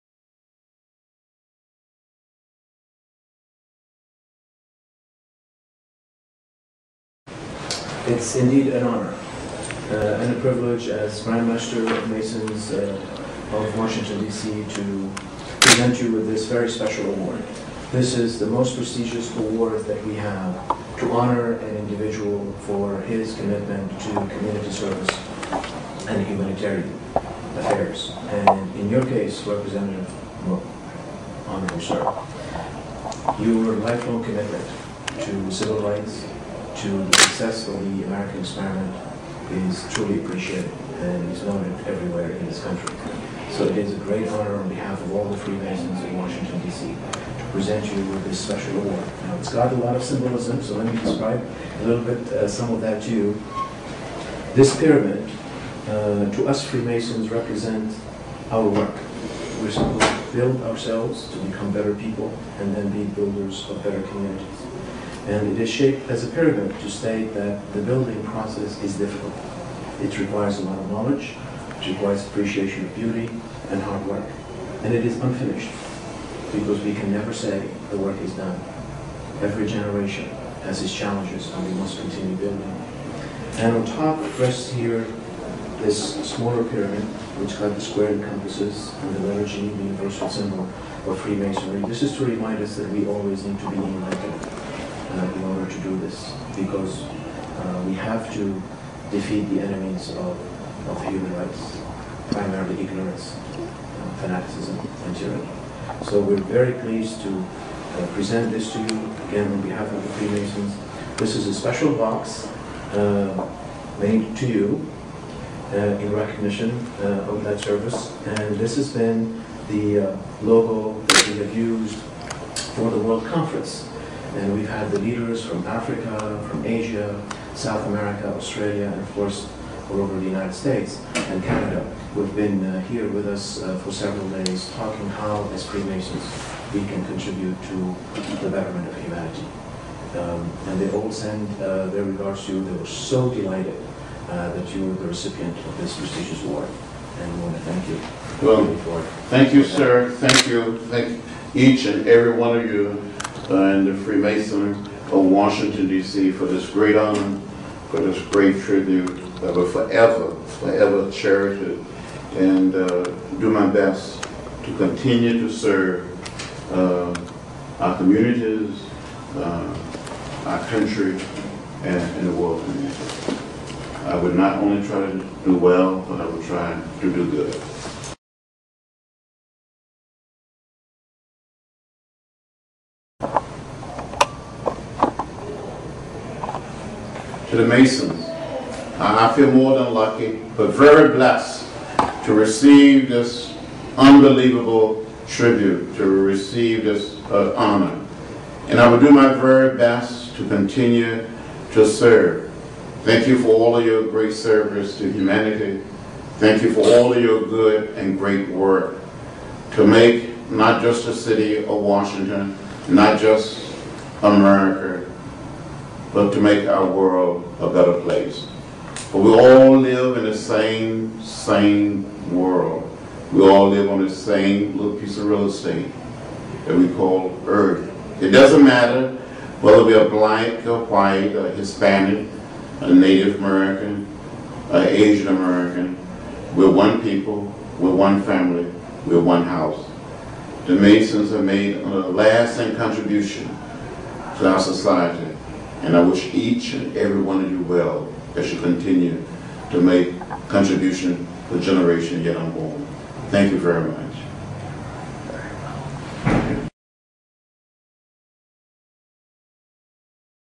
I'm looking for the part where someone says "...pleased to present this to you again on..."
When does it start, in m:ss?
1:46.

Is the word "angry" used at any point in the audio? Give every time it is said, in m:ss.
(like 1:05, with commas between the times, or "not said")
not said.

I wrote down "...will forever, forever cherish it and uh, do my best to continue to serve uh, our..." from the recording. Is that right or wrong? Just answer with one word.
right.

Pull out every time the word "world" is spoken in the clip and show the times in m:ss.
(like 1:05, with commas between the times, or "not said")
2:02, 2:52, 3:36, 3:42.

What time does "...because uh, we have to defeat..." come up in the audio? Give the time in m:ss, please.
1:36.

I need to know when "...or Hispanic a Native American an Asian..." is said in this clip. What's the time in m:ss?
3:51.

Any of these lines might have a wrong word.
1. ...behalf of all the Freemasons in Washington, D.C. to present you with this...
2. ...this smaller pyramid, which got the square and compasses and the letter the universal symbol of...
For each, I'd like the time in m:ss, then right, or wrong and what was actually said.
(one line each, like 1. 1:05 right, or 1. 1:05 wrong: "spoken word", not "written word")
1. 0:44 right
2. 1:25 right.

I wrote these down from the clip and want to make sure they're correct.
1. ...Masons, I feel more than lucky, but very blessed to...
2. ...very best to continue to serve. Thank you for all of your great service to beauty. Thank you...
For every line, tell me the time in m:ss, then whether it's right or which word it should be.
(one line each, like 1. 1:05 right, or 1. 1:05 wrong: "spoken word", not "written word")
1. 3:07 right
2. 3:19 wrong: "humanity", not "beauty".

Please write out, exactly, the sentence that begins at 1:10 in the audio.
It requires a lot of knowledge, it requires appreciation of beauty and hard work.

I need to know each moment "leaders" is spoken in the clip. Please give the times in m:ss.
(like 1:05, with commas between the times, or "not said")
2:04.